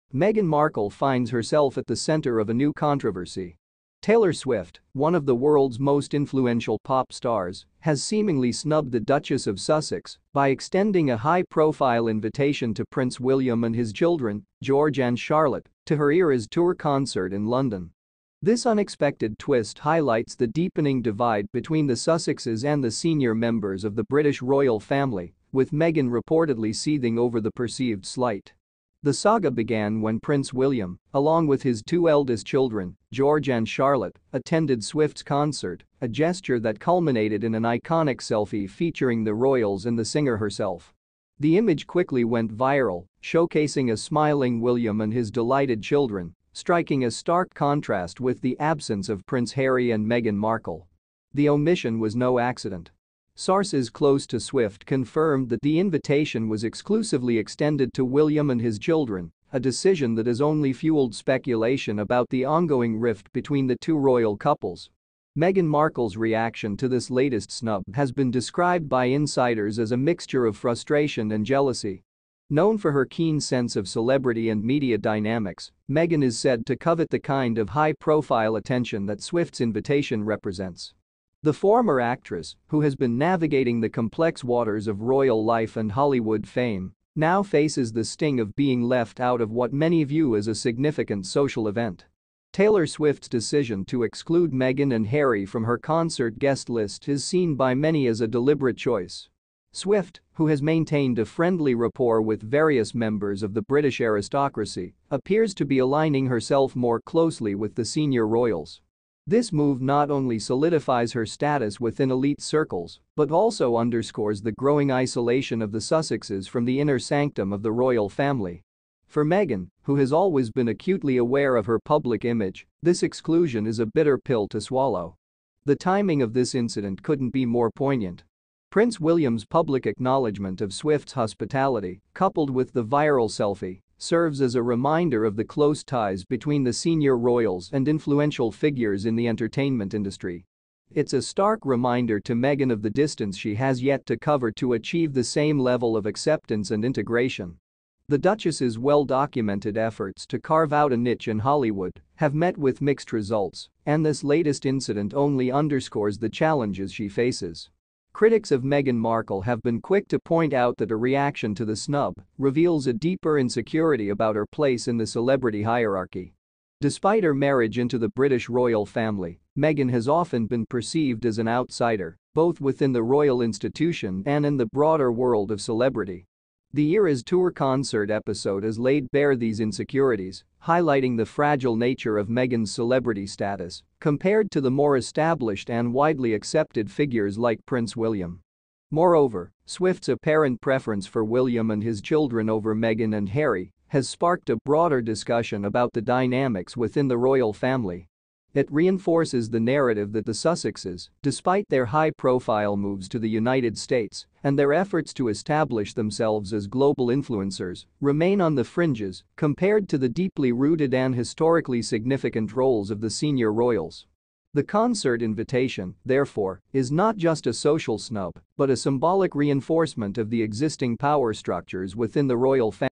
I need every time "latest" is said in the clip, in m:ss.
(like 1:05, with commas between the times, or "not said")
1:07, 2:34.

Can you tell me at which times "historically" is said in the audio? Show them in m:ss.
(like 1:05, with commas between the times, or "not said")
3:31.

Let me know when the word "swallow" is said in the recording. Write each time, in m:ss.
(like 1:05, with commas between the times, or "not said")
2:04.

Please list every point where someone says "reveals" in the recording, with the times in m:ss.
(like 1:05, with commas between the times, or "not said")
2:42.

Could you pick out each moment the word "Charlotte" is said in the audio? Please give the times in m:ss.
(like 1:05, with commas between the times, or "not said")
0:15, 0:33.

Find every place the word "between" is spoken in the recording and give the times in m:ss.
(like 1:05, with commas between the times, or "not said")
0:21, 1:03, 2:16.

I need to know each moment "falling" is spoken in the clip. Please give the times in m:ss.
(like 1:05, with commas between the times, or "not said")
not said.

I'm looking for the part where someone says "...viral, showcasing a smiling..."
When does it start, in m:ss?
0:42.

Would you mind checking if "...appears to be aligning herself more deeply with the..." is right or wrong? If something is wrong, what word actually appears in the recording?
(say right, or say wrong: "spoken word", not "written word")
wrong: "closely", not "deeply".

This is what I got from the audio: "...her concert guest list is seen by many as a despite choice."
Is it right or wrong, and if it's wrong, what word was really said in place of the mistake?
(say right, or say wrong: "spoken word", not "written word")
wrong: "deliberate", not "despite".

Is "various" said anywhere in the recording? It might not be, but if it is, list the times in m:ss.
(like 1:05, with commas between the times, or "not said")
1:42.